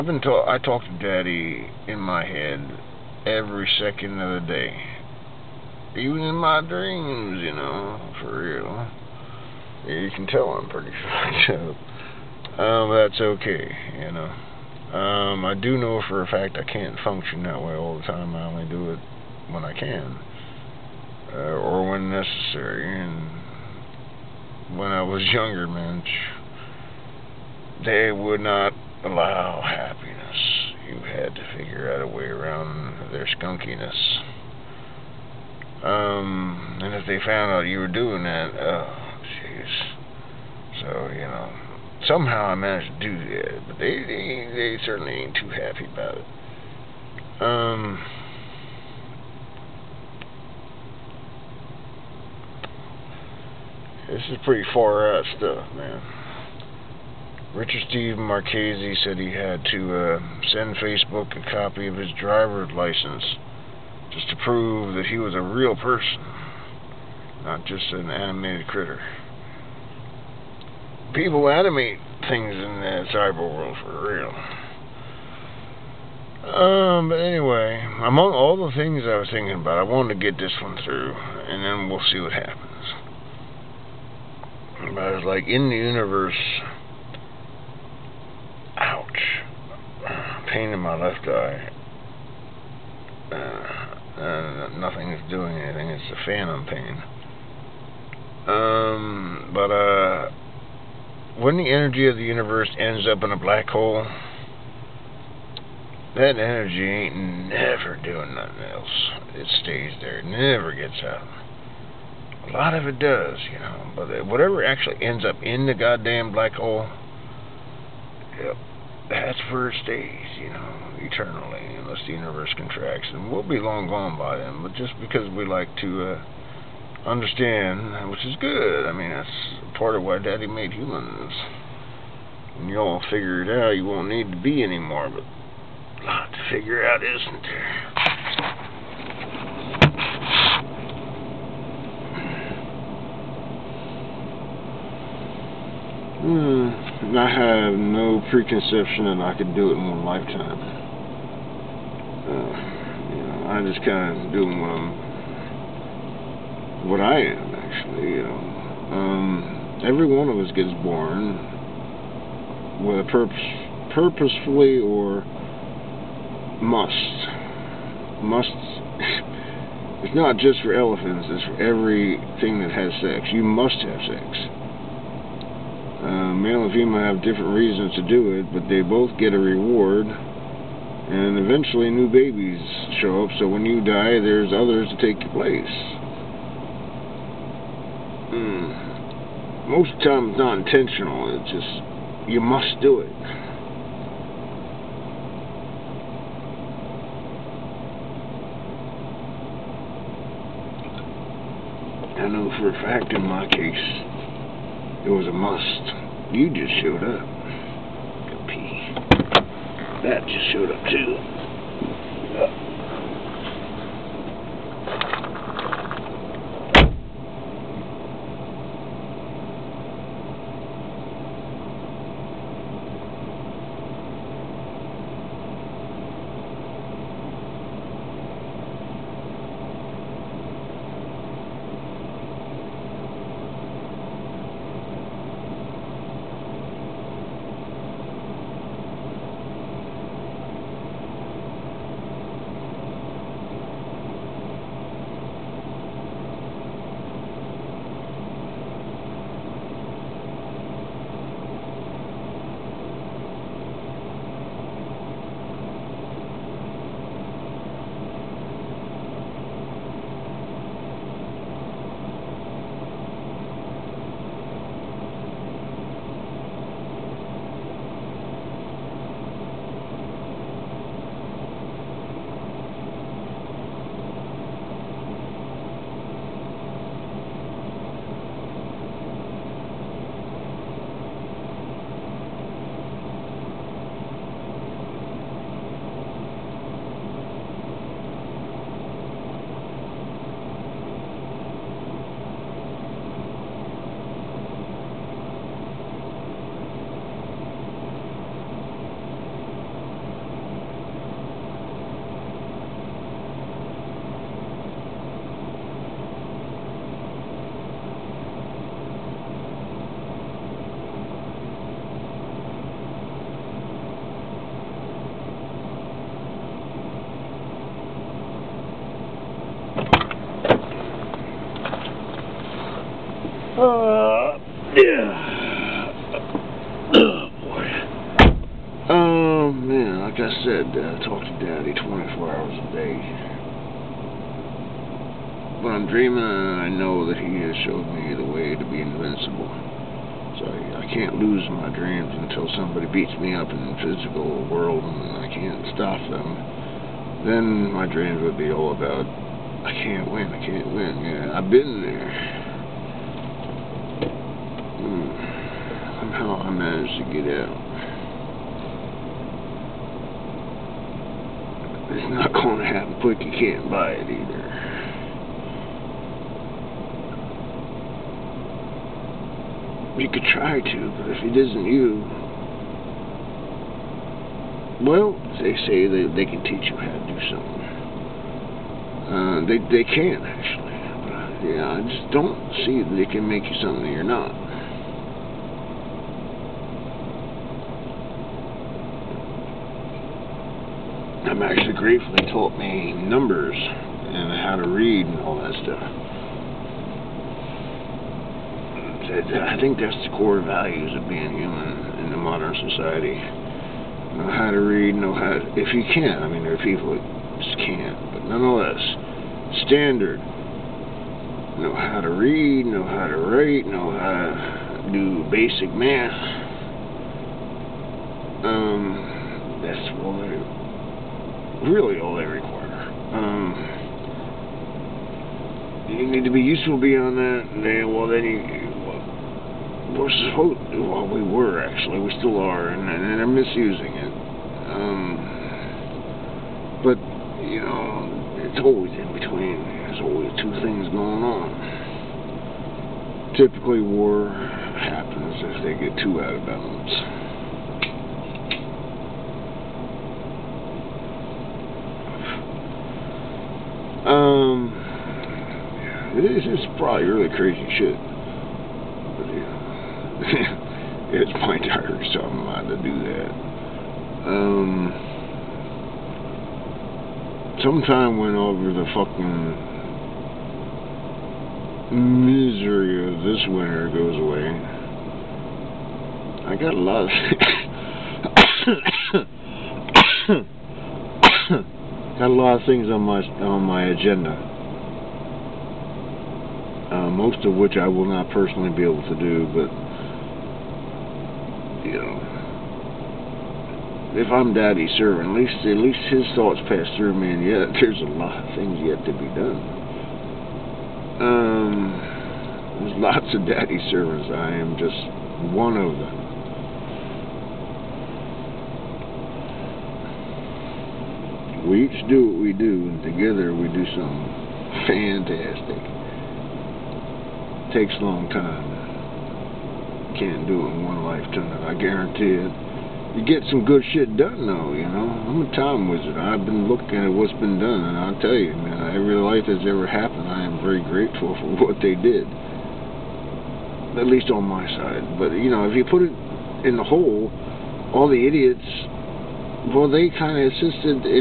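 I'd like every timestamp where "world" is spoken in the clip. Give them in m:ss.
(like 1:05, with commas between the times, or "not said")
1:13, 5:44.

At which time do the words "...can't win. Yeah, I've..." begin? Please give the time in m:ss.
5:50.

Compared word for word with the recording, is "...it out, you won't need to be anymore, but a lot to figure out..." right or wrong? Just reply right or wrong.
right.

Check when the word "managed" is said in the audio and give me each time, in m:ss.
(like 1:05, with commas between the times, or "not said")
0:42, 5:56.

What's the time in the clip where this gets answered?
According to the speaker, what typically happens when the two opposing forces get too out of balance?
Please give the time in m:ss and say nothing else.
7:23.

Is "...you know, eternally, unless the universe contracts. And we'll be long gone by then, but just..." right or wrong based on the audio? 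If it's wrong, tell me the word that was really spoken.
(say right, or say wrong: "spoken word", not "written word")
right.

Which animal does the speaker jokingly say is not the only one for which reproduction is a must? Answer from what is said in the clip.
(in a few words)
elephants.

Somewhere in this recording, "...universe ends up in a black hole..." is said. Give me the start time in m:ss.
1:42.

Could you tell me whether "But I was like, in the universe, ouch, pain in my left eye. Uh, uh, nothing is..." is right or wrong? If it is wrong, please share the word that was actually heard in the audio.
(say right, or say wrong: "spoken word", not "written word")
right.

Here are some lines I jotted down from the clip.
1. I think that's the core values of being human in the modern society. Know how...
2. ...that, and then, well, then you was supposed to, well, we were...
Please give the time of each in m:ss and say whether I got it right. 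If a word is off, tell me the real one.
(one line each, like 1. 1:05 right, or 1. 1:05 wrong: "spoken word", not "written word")
1. 6:39 right
2. 7:07 right.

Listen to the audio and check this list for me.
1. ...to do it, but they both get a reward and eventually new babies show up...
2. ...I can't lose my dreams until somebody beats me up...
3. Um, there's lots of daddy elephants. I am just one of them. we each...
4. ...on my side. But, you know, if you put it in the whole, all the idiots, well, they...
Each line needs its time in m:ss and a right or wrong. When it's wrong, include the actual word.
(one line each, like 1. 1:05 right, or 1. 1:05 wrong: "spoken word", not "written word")
1. 2:57 right
2. 5:40 right
3. 8:21 wrong: "servants", not "elephants"
4. 8:54 right.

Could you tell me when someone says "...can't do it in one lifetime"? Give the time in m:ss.
8:40.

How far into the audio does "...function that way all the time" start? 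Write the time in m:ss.
0:17.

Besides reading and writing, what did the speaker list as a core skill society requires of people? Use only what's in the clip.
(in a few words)
basic math.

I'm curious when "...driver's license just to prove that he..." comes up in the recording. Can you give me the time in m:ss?
1:02.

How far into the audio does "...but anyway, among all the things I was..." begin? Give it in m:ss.
1:17.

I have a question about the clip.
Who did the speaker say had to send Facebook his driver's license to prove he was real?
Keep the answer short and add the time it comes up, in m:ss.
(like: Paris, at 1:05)
Richard Steve Marchese, at 0:57.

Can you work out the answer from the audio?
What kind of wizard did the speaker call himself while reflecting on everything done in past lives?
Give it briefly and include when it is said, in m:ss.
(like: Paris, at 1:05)
time wizard, at 8:45.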